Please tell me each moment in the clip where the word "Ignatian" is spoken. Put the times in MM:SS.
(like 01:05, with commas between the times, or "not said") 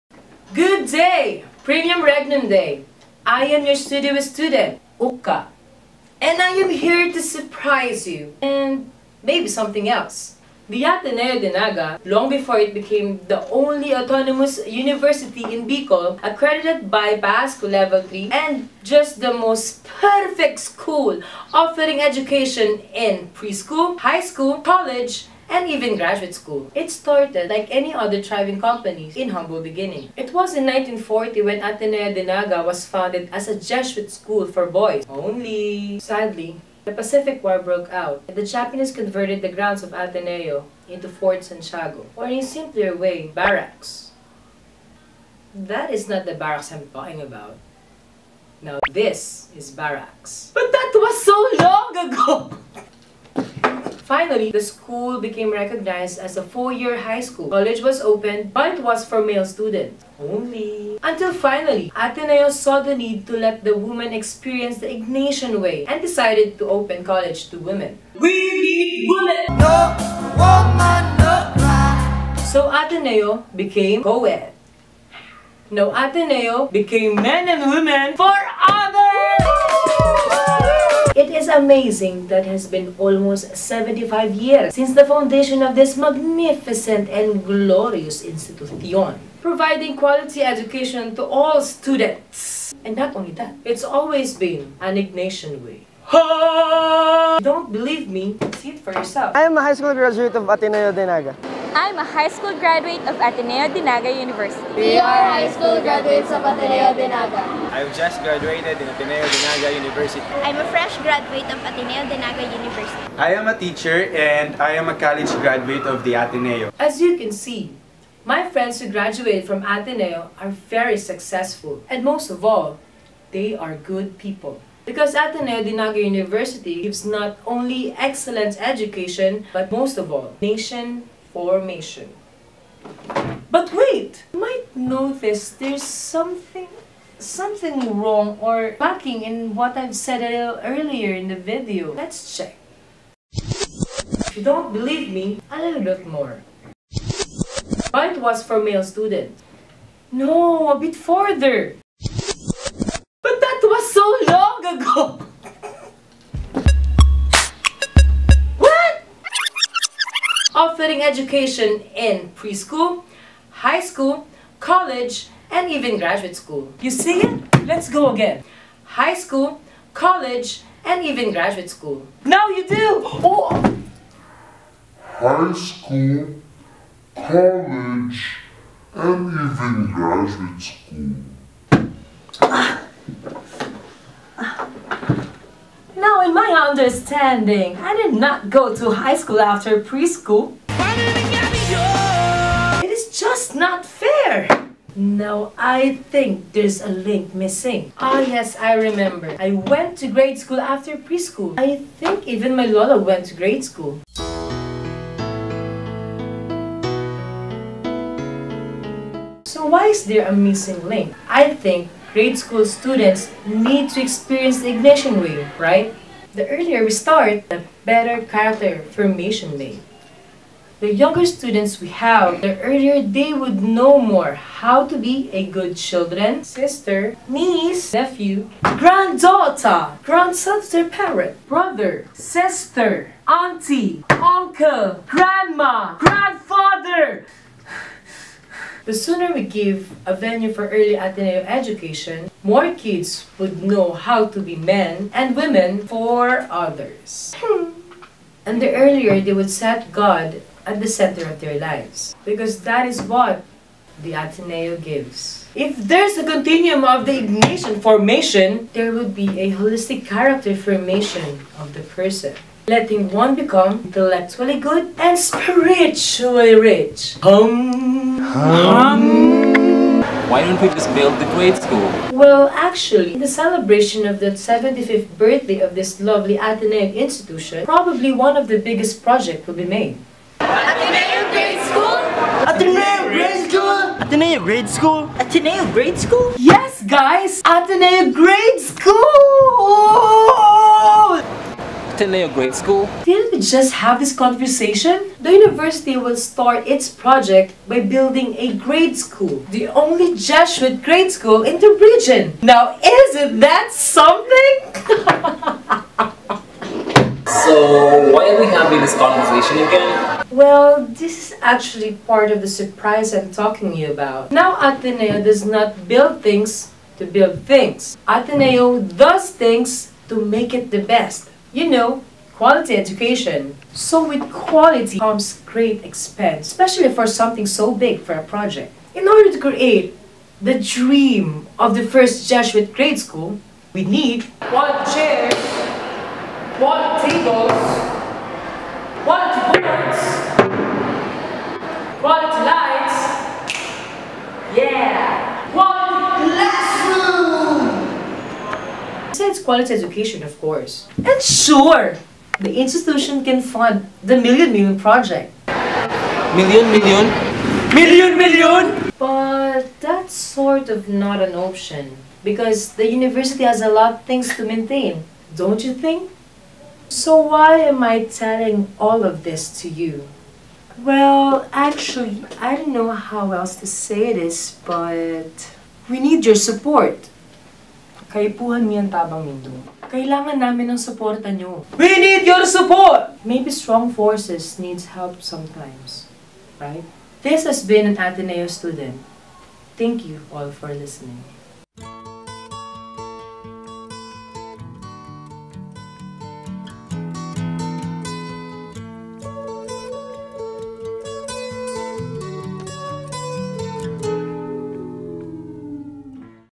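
01:04, 01:34, 03:34, 04:17.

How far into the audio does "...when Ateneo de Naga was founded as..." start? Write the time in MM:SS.
00:31.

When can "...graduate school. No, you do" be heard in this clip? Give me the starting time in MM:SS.
02:51.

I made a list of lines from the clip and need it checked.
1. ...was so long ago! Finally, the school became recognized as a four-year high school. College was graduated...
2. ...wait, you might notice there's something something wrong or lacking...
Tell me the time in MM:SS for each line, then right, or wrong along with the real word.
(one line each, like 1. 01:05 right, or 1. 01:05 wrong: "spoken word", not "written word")
1. 00:50 wrong: "opened", not "graduated"
2. 02:13 right.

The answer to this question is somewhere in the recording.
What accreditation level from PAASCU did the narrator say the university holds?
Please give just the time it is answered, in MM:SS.
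00:17.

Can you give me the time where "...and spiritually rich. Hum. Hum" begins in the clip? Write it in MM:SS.
04:24.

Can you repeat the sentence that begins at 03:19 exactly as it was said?
I went to grade school after preschool.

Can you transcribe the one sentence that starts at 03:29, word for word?
So why is there a missing link?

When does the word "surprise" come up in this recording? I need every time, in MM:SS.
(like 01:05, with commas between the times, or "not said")
00:07, 05:12.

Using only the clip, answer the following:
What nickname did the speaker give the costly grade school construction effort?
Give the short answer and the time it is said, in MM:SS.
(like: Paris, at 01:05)
Million Million Project, at 05:54.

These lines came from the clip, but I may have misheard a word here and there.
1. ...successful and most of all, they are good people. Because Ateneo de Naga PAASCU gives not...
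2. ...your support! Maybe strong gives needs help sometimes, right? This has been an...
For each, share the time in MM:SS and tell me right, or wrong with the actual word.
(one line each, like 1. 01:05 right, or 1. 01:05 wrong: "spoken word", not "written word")
1. 02:00 wrong: "University", not "PAASCU"
2. 06:22 wrong: "forces", not "gives".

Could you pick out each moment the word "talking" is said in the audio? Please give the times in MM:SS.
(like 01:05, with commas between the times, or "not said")
00:46, 05:13.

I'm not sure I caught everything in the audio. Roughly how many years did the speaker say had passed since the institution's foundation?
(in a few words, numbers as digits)
75.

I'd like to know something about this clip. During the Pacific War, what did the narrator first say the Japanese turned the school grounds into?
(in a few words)
Fort Santiago.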